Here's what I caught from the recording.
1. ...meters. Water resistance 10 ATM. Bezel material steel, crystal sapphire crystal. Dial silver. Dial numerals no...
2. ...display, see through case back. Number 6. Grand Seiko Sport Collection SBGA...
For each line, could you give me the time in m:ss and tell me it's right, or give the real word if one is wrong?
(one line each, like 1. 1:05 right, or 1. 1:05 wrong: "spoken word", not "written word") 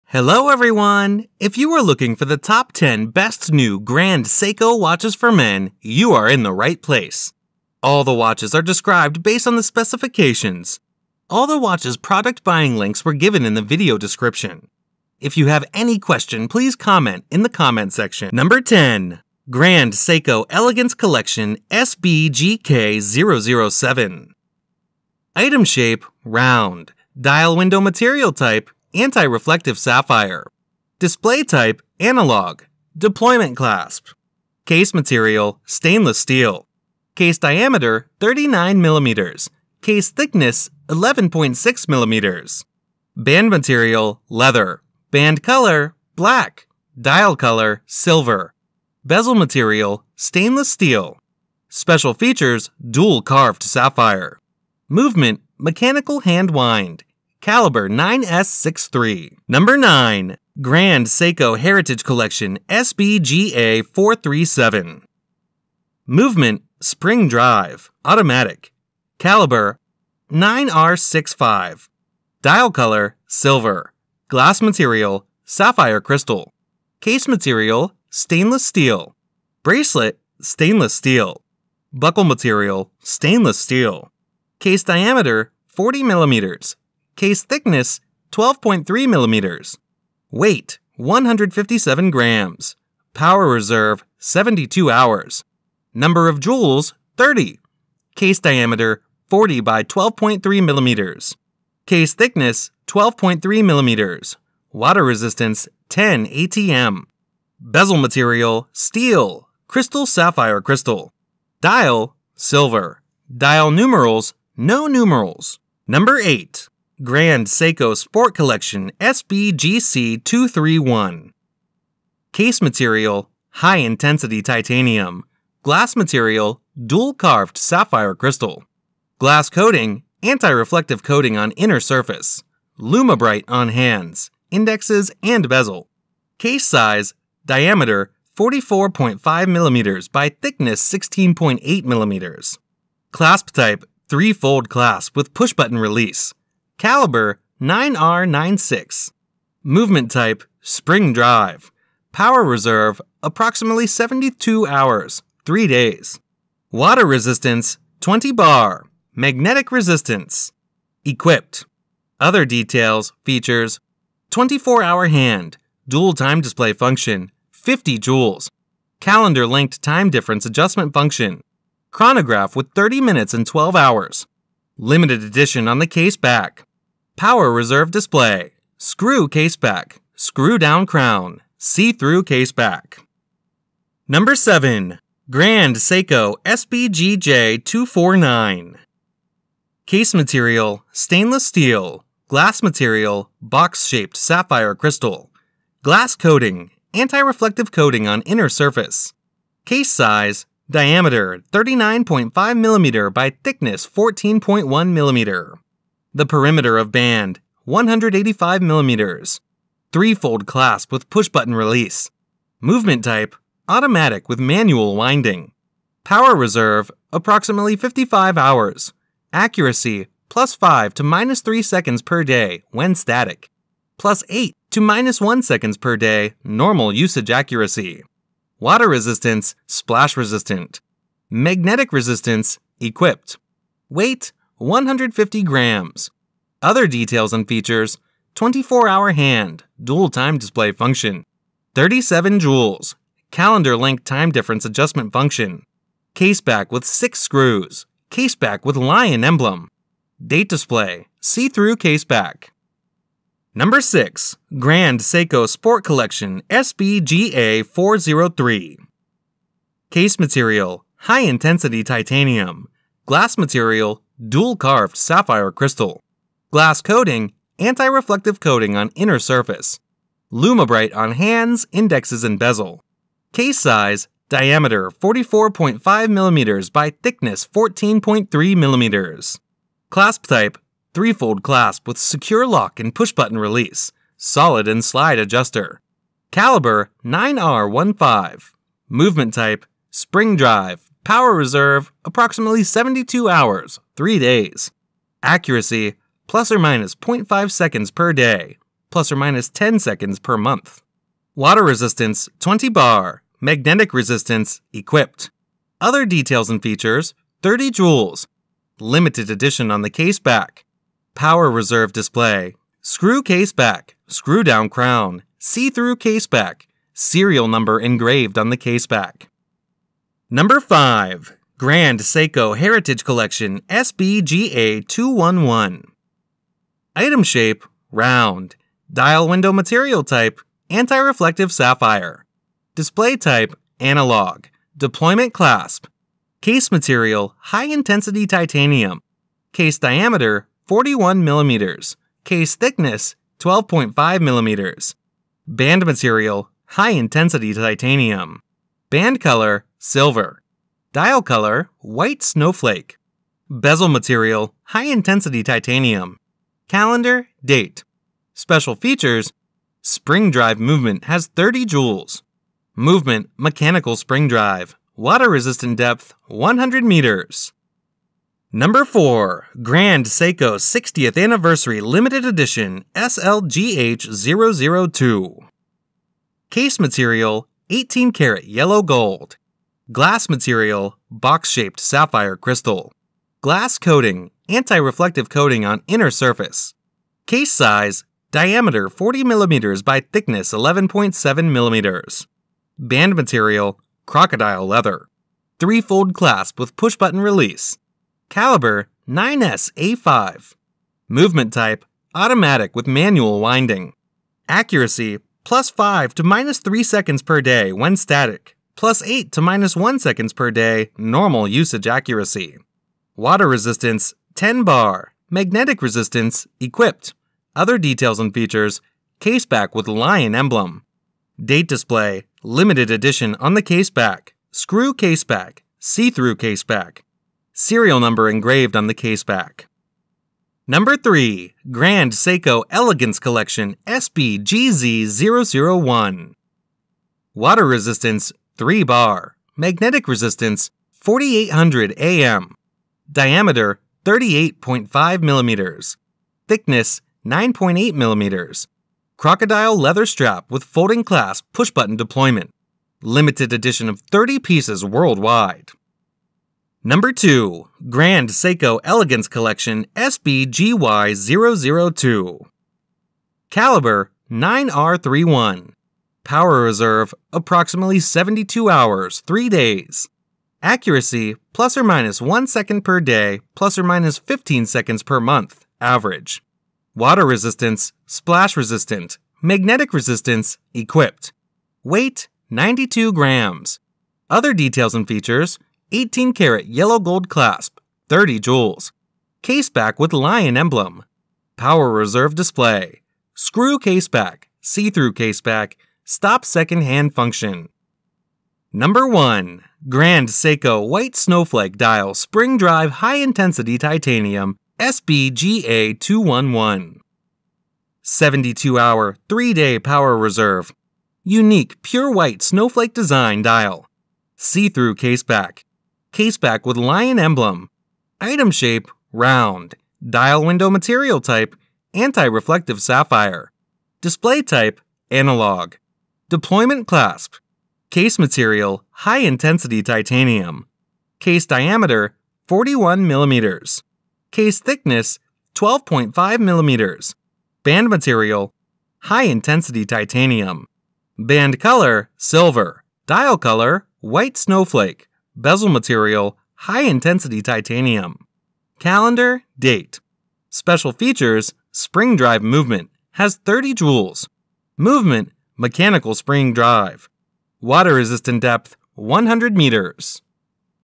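1. 1:43 wrong: "millimeters", not "meters"
2. 4:10 right.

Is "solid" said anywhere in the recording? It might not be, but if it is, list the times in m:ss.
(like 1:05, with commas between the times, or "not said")
4:44.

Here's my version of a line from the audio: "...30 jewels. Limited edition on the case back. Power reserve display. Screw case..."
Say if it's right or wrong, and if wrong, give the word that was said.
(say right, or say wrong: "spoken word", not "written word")
right.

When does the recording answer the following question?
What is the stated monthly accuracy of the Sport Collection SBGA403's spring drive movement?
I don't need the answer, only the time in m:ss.
4:58.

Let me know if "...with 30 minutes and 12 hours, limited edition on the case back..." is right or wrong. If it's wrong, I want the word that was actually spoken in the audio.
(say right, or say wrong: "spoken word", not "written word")
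right.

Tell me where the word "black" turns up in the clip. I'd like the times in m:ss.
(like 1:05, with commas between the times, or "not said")
0:46.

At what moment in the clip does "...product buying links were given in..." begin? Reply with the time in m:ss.
0:11.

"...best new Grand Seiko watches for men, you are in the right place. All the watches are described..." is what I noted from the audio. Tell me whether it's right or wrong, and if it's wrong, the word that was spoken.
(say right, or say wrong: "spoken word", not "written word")
right.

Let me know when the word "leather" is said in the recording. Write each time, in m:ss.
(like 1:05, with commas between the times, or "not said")
0:44, 6:34, 7:29.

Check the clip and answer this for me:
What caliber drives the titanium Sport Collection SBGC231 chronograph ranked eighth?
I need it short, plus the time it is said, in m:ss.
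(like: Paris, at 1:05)
9R96, at 2:26.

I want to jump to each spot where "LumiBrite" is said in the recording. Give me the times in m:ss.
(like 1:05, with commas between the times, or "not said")
2:12, 4:30.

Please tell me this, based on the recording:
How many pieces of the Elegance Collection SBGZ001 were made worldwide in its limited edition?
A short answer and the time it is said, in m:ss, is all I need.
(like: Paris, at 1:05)
30, at 7:34.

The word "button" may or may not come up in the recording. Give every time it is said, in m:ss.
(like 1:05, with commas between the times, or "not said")
2:25, 3:31, 4:42, 6:36, 7:31.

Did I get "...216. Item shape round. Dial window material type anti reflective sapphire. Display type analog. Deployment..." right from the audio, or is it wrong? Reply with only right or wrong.
wrong.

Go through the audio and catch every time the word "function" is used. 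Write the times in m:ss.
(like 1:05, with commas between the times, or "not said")
2:46, 2:50, 4:00, 4:05, 8:17.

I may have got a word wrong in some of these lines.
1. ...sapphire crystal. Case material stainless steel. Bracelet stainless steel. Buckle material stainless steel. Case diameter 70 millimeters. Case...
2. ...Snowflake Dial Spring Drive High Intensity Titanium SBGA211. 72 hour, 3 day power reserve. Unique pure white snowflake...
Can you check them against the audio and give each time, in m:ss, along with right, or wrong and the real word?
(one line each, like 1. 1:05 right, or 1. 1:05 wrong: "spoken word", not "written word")
1. 1:15 wrong: "40", not "70"
2. 8:21 right.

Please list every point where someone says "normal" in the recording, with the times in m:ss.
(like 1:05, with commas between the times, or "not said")
3:46, 6:50.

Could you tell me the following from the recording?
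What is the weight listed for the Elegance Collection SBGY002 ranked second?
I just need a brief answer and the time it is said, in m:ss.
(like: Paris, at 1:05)
92 grams, at 8:02.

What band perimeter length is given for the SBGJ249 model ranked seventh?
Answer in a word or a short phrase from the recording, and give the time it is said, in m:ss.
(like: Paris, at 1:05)
185 millimeters, at 3:27.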